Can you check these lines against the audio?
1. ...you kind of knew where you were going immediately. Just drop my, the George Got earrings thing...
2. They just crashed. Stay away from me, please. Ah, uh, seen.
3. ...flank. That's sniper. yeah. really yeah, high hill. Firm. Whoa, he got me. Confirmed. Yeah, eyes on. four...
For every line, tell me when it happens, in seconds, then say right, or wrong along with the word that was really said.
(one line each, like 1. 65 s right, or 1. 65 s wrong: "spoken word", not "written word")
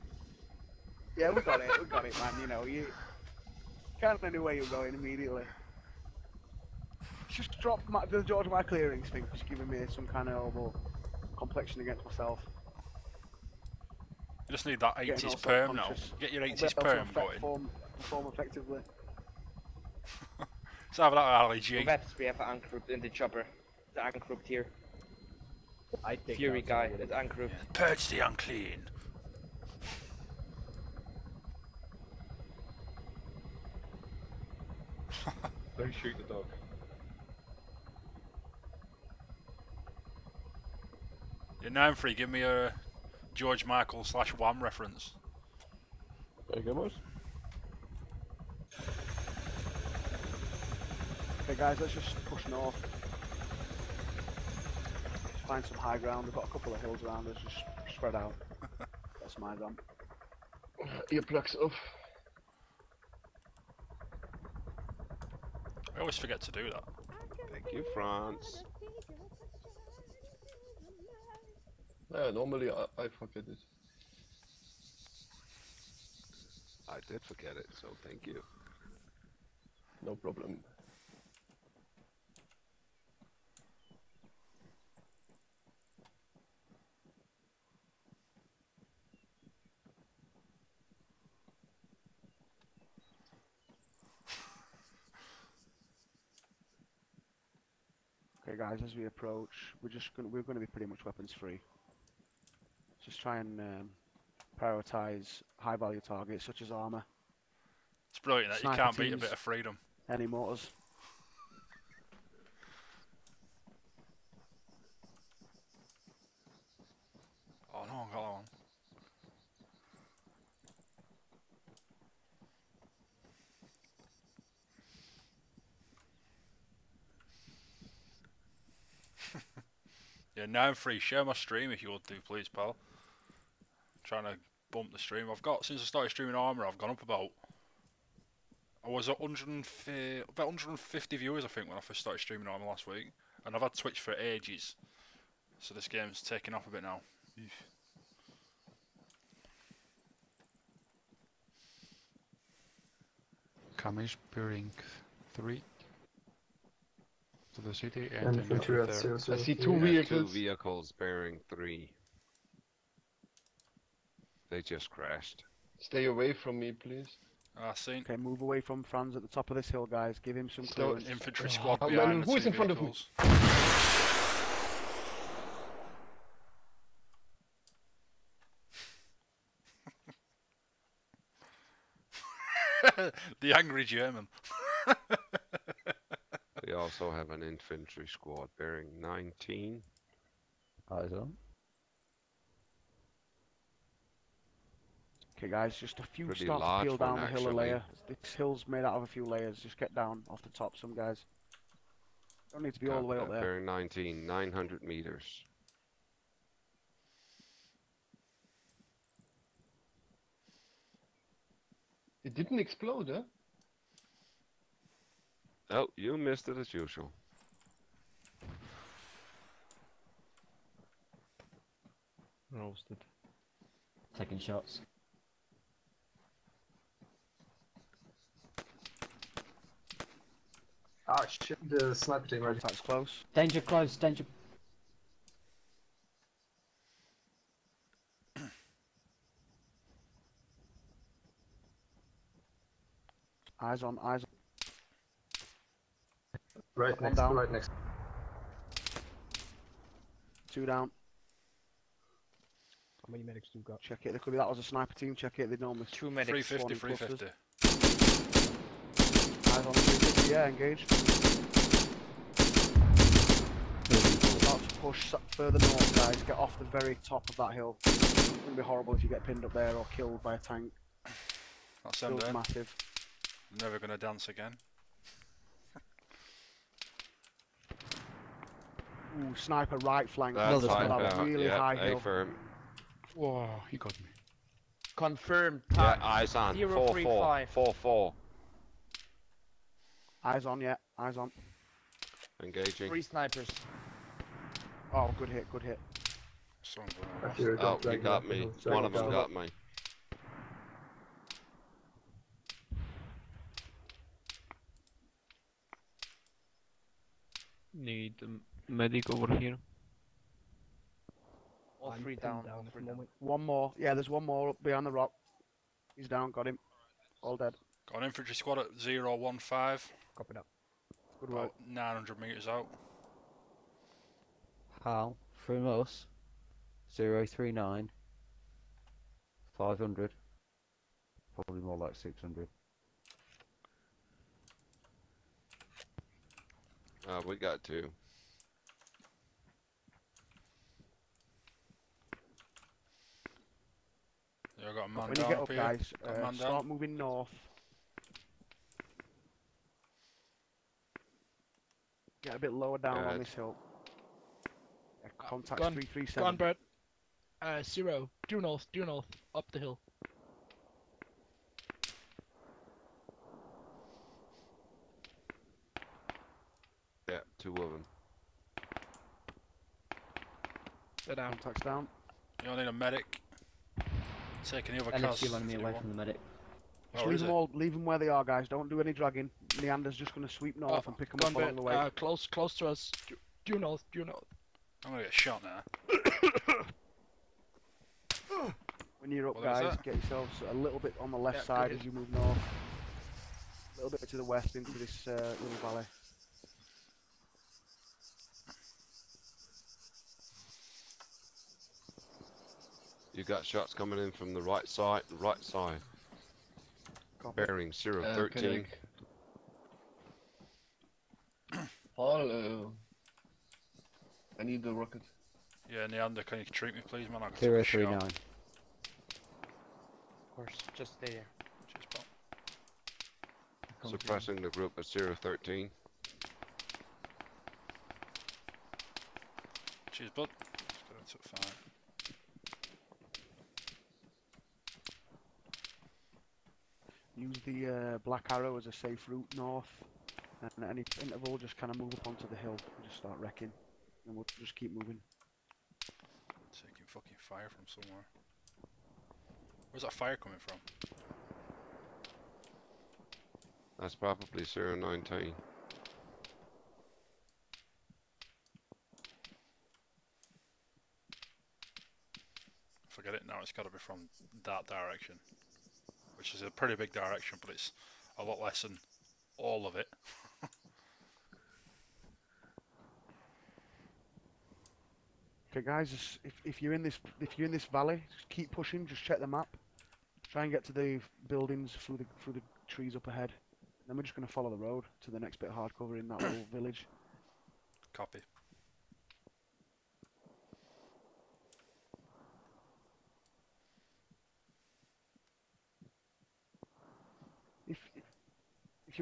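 1. 2 s wrong: "Michael", not "Got"
2. 164 s right
3. 280 s right.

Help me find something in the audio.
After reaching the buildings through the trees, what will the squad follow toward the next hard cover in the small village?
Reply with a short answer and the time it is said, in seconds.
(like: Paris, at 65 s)
the road, at 484 s.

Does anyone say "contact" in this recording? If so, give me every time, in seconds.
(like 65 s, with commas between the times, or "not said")
355 s, 371 s.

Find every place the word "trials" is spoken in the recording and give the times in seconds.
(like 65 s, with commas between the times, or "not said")
not said.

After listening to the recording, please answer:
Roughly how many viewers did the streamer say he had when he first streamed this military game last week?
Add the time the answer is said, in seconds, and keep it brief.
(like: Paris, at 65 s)
150, at 140 s.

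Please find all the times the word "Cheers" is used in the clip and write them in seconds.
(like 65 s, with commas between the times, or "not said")
423 s, 429 s.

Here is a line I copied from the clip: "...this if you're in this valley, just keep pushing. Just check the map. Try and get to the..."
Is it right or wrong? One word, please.
right.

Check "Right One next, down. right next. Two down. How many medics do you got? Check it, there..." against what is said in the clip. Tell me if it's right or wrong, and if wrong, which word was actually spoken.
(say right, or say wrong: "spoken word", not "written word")
right.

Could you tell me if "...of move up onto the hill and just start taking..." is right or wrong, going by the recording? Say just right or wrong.
wrong.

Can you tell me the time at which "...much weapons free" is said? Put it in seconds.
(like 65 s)
100 s.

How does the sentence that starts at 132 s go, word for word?
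I'm trying to bump the stream.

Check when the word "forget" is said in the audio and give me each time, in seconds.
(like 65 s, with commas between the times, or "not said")
66 s, 73 s, 77 s, 462 s.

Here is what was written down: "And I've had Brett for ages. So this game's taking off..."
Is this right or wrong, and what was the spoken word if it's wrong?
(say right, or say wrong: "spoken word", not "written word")
wrong: "Twitch", not "Brett".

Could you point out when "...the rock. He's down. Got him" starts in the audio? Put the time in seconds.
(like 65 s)
314 s.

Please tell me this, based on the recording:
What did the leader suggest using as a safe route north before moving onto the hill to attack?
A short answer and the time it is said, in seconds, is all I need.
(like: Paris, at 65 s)
Black Arrow, at 438 s.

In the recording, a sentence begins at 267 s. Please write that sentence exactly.
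It's going to be horrible if you get pinned up there or killed by a tank.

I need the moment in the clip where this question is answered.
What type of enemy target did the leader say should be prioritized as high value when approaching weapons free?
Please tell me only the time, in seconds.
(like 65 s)
106 s.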